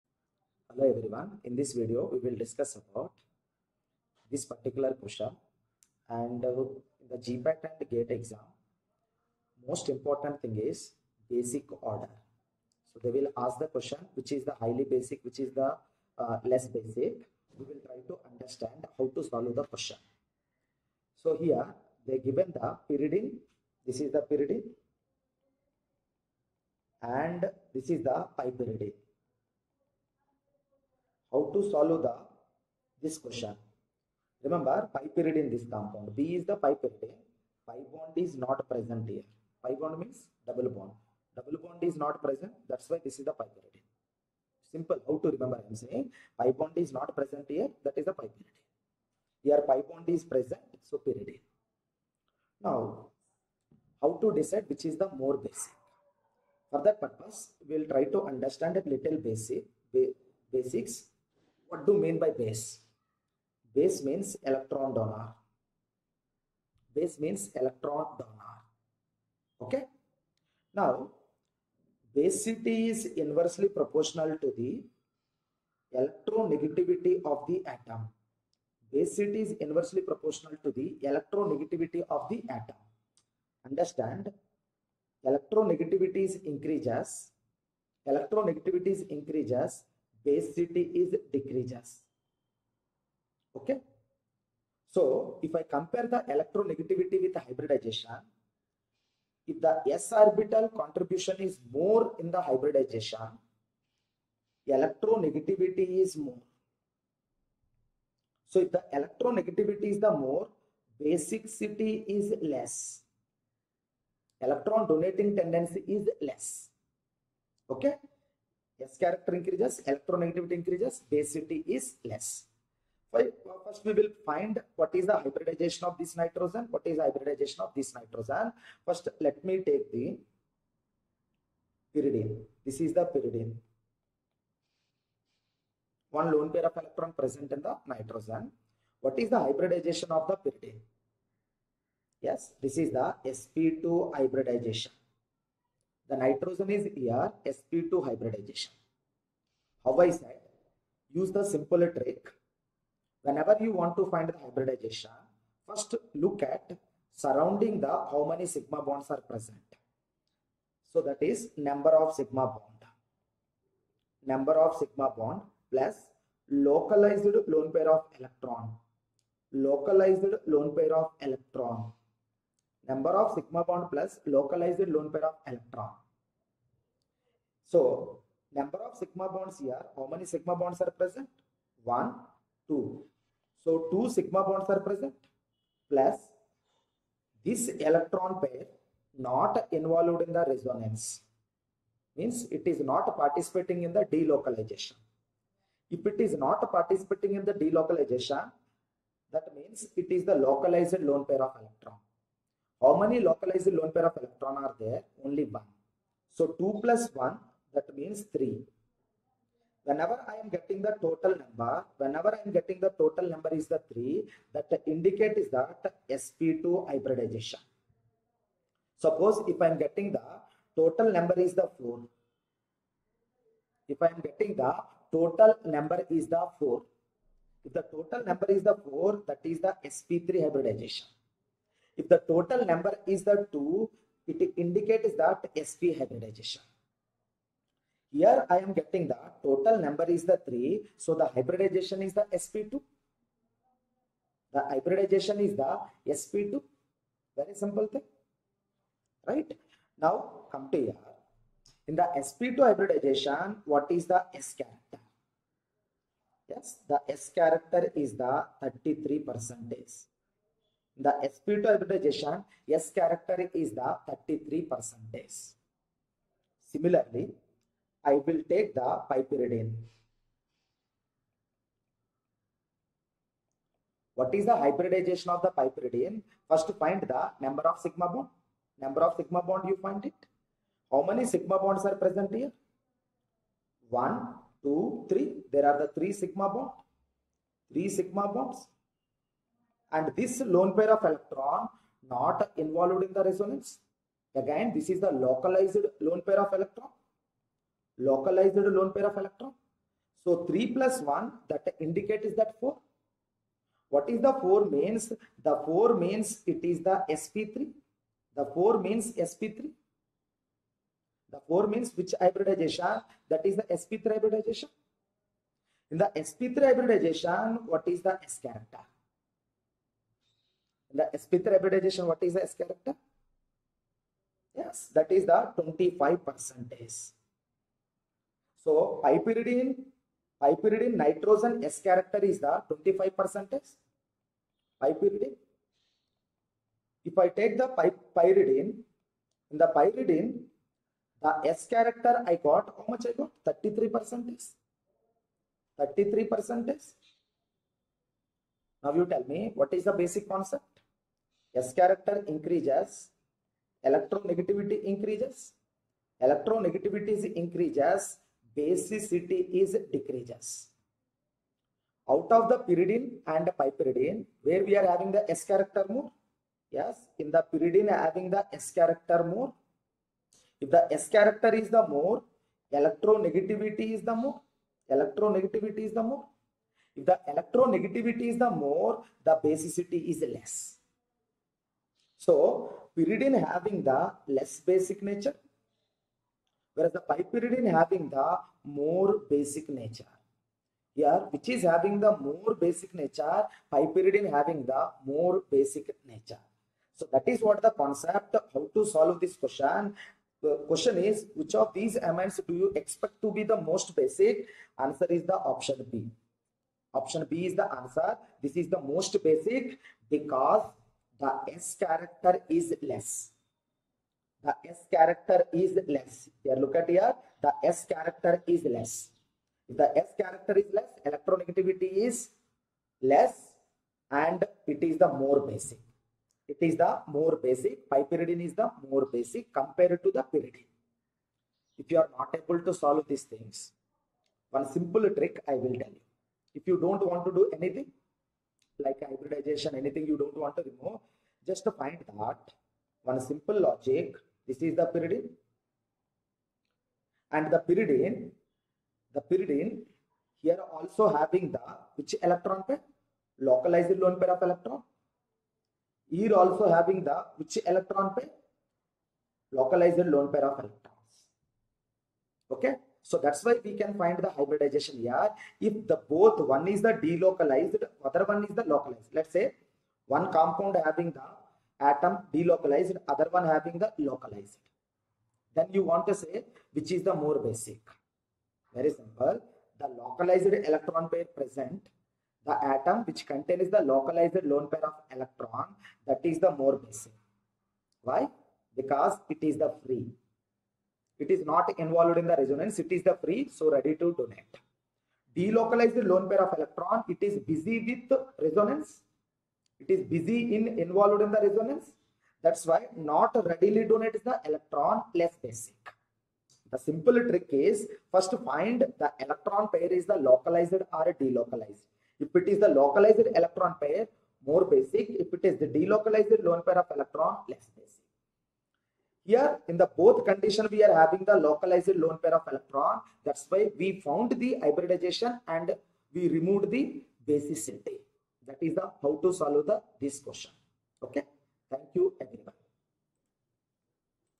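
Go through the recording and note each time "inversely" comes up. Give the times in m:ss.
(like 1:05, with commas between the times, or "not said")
1:13, 1:19.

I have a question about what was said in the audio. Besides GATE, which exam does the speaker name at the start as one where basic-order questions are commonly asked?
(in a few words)
GPAT.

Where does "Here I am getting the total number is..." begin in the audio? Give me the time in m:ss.
3:58.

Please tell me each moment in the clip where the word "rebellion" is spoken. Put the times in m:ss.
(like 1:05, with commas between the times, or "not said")
not said.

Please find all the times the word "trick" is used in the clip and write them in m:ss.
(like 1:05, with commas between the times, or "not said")
2:31, 7:15, 8:27.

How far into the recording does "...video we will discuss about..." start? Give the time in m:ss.
0:01.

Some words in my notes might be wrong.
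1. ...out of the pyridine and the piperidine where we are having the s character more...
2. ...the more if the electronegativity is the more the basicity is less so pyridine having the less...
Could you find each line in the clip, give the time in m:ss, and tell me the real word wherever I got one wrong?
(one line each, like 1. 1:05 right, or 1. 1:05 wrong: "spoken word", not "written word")
1. 6:02 right
2. 6:15 right.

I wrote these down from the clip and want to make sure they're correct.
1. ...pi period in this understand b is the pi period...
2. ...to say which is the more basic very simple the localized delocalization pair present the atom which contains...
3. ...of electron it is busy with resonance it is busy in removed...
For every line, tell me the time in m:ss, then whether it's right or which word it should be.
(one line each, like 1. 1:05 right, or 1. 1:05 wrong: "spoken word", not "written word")
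1. 0:34 wrong: "compound", not "understand"
2. 7:56 wrong: "electron", not "delocalization"
3. 8:16 wrong: "involved", not "removed".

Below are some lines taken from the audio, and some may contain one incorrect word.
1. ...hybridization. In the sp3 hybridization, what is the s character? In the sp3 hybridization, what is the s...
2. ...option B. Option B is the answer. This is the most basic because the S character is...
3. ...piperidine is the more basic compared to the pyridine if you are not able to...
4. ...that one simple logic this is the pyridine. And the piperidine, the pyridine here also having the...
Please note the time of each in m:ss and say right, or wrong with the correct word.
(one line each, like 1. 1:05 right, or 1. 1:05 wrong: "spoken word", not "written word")
1. 5:14 right
2. 6:45 right
3. 7:07 right
4. 7:22 wrong: "pyridine", not "piperidine".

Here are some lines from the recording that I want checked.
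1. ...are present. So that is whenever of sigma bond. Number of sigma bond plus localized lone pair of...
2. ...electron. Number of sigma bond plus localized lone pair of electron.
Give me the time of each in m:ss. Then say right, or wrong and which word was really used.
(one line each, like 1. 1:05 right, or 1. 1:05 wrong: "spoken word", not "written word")
1. 2:39 wrong: "number", not "whenever"
2. 2:51 right.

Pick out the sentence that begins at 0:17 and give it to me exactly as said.
We will try to understand how to solve the question.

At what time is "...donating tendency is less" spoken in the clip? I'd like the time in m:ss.
1:54.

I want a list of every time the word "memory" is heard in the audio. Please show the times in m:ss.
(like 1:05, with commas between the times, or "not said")
not said.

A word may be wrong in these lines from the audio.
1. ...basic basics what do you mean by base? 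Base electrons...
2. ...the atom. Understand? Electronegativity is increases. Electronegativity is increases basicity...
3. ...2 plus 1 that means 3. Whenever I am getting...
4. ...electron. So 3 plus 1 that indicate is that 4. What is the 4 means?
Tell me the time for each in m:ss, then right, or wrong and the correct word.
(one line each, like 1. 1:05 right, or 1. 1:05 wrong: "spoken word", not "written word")
1. 0:59 wrong: "means", not "electrons"
2. 1:22 right
3. 3:26 right
4. 4:59 right.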